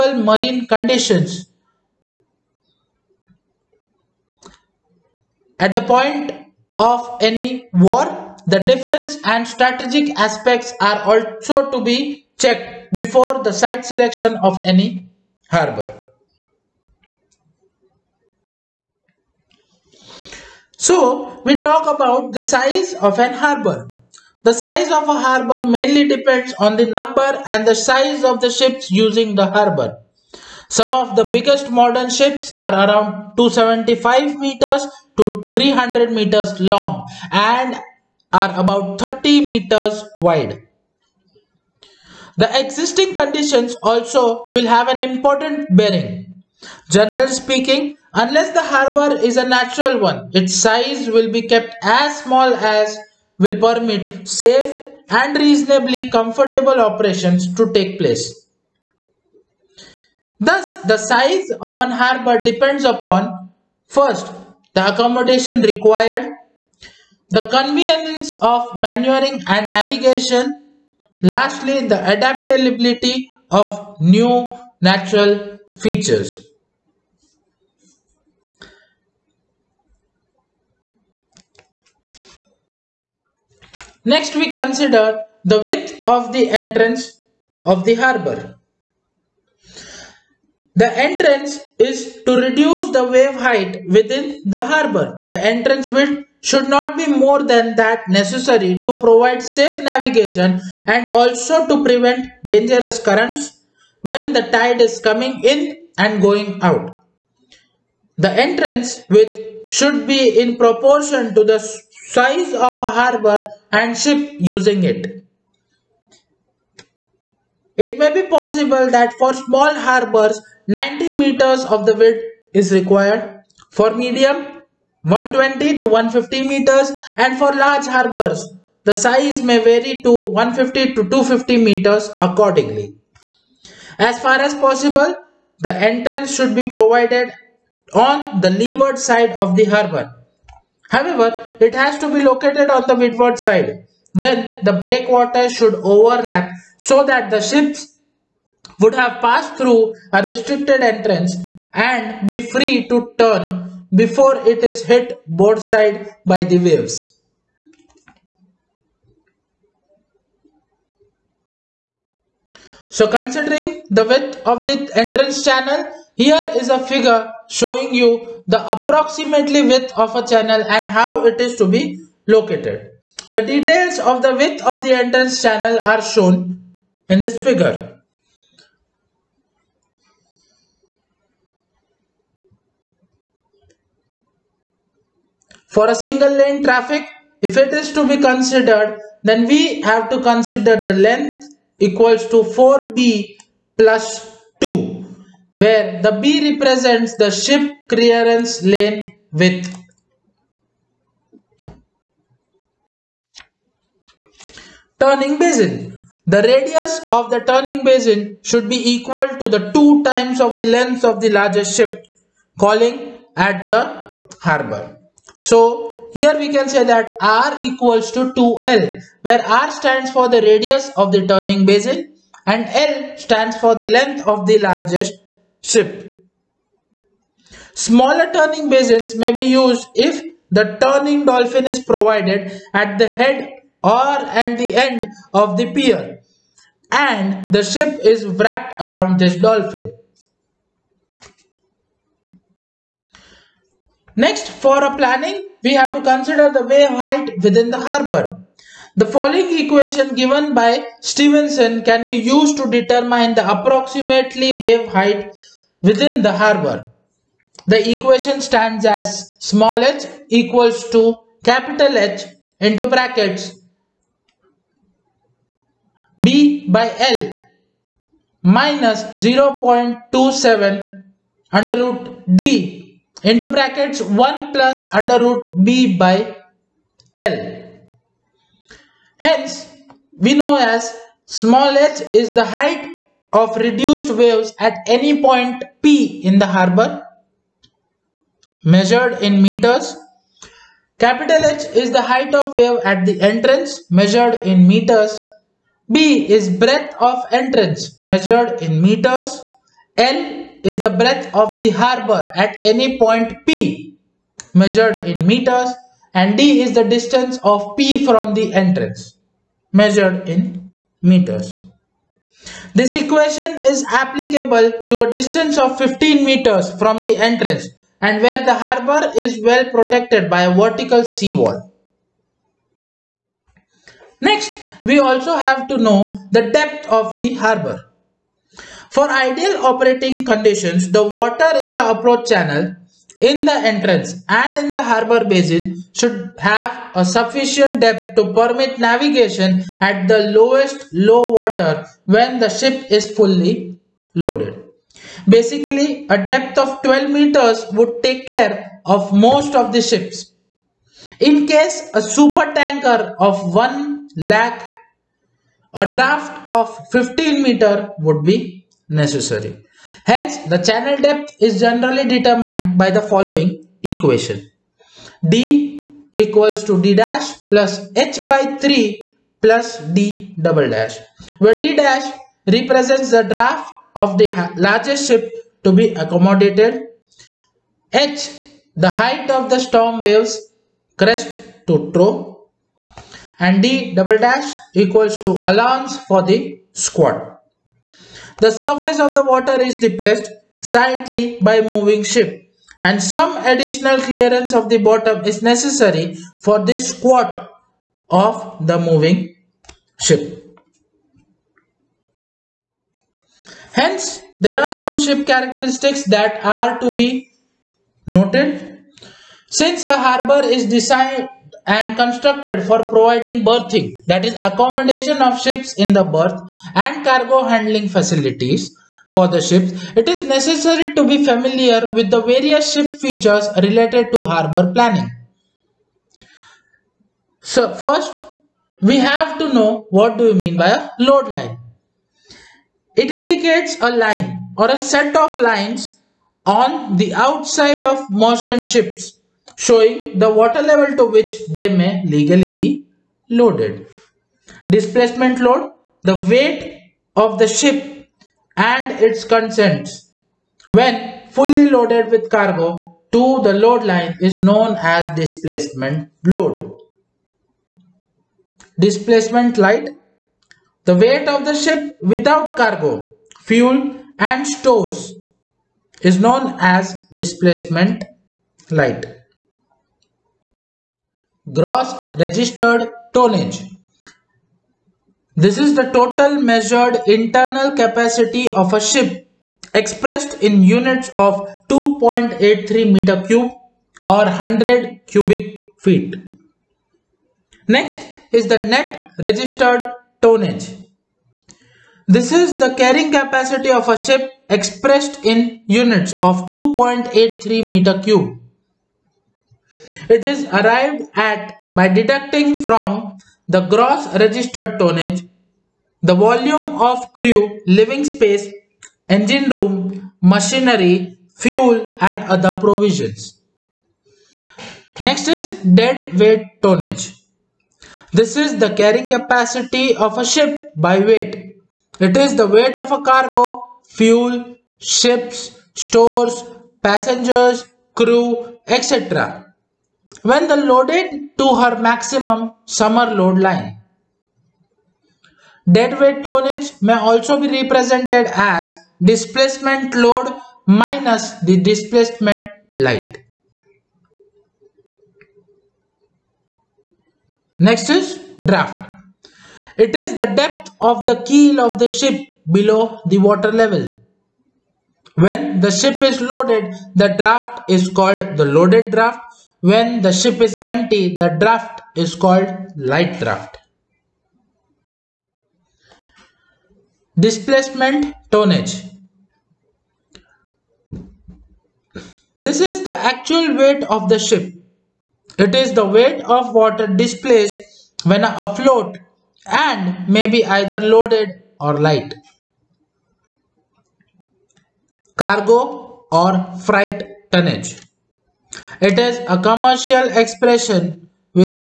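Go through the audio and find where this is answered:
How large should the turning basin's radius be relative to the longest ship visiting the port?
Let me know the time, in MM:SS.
03:29.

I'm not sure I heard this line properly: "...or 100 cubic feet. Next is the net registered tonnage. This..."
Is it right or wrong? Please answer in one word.
right.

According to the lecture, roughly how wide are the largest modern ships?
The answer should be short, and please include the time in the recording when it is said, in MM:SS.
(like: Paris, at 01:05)
30 meters, at 00:39.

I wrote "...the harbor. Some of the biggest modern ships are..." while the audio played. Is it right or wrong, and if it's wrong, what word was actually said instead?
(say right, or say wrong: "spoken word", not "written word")
right.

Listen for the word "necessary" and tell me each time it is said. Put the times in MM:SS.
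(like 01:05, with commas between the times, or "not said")
01:38, 05:58, 06:35, 07:00.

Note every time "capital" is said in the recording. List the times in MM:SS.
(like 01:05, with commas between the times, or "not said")
04:21, 04:50.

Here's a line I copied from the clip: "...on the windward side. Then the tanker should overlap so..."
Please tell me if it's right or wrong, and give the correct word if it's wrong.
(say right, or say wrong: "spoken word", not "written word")
wrong: "breakwater", not "tanker".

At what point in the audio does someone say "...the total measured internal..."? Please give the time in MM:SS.
07:55.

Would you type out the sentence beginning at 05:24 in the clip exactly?
Next, we also have to know the depth of the harbor.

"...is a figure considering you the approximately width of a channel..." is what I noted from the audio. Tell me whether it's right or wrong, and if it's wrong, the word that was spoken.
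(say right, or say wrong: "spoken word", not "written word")
wrong: "showing", not "considering".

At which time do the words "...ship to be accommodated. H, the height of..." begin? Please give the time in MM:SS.
06:15.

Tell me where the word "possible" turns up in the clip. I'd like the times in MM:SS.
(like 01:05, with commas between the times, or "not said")
01:58, 02:14.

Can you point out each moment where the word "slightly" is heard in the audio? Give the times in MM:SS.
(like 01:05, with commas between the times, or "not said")
06:30.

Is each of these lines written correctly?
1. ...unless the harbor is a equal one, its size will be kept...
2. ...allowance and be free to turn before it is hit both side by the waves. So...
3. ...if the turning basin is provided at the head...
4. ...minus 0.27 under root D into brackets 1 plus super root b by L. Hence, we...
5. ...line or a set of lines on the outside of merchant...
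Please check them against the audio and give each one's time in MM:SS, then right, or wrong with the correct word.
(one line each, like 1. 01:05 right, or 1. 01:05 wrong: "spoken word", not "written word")
1. 00:48 wrong: "natural", not "equal"
2. 02:30 wrong: "entrance", not "allowance"
3. 03:49 wrong: "dolphin", not "basin"
4. 04:28 wrong: "under", not "super"
5. 07:14 right.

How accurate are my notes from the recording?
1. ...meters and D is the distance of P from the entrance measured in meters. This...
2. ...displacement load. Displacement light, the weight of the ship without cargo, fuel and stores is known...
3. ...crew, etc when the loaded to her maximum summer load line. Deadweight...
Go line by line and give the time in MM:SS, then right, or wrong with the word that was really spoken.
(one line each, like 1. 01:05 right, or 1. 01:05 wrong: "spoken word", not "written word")
1. 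05:05 right
2. 07:35 right
3. 08:47 right.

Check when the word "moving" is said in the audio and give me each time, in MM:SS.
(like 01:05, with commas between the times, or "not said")
06:31, 06:38.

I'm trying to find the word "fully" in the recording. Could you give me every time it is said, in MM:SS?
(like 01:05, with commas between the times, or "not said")
05:43, 07:31.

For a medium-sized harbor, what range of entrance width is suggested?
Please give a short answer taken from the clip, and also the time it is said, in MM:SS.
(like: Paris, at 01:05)
120 to 150 meters, at 02:05.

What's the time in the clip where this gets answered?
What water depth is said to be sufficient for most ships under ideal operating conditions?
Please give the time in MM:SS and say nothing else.
05:46.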